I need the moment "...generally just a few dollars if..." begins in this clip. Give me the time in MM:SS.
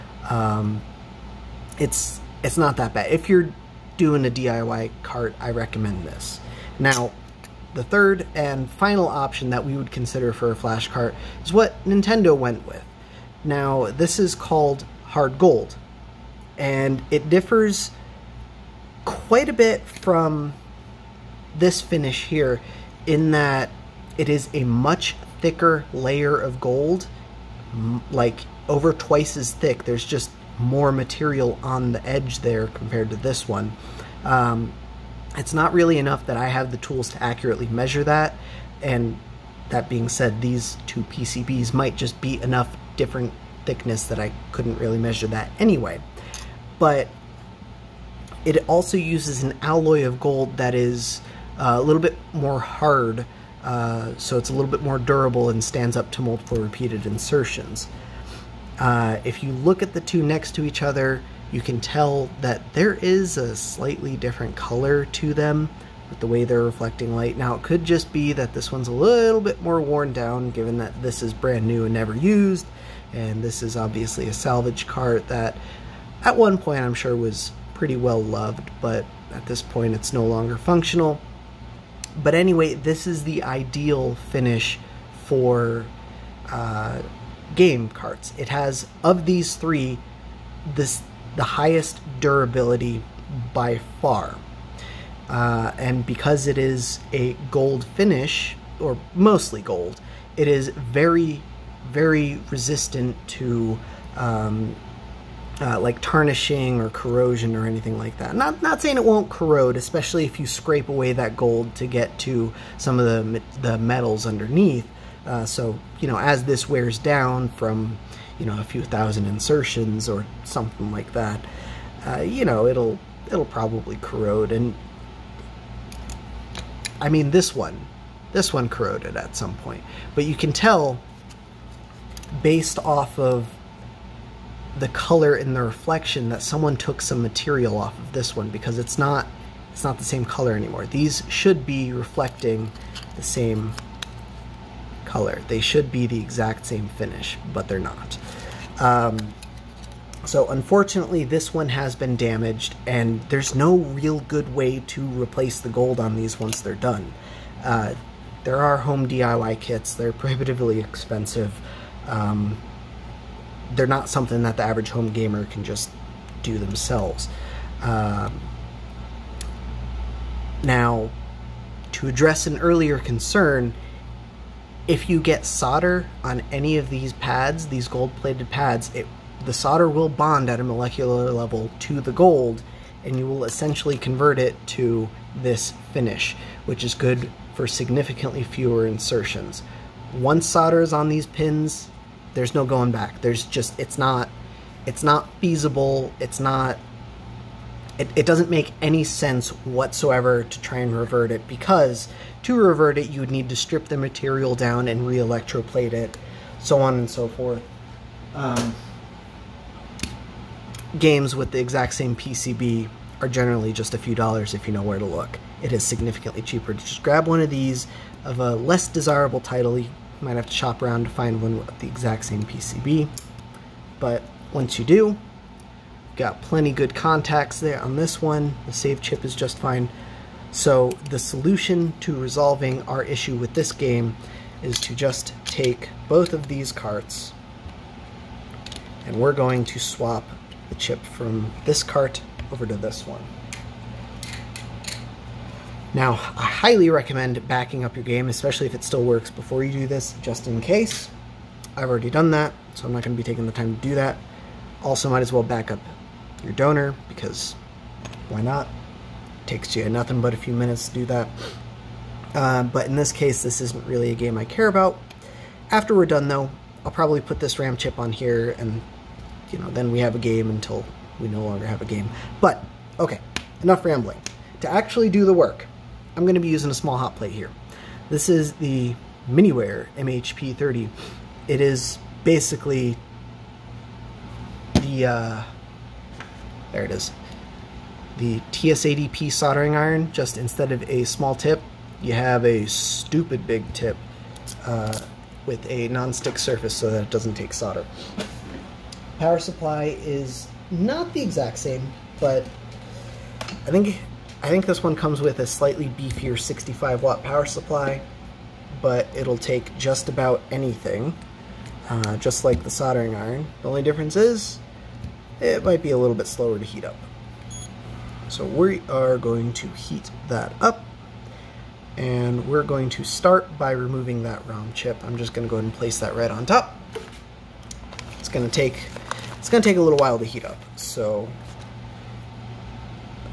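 03:33.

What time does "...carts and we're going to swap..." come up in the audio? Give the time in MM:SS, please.
03:56.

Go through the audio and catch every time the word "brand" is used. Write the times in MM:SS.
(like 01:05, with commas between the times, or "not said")
01:11.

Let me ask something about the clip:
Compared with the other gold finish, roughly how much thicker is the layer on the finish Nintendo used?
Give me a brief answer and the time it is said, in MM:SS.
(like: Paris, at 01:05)
over twice as thick, at 00:28.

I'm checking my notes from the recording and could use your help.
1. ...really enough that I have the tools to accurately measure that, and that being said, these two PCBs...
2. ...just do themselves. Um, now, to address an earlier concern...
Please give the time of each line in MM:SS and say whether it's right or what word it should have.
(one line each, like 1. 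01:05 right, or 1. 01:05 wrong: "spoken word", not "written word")
1. 00:35 right
2. 02:45 right.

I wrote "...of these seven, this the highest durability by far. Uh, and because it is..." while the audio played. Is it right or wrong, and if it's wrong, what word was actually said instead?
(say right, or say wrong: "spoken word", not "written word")
wrong: "three", not "seven".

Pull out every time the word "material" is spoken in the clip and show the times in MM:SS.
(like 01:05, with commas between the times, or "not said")
00:30, 02:17, 03:23.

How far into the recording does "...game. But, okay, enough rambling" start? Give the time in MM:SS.
04:31.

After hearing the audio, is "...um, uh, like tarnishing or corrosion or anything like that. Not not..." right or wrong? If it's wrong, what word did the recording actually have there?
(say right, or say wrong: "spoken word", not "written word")
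right.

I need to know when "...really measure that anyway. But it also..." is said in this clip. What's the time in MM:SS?
00:44.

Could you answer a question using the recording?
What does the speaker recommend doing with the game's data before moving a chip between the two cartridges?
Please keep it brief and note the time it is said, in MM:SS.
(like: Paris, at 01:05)
backing up, at 04:07.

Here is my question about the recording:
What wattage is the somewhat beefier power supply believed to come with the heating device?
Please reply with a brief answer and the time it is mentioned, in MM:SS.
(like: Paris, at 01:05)
65 watt, at 05:06.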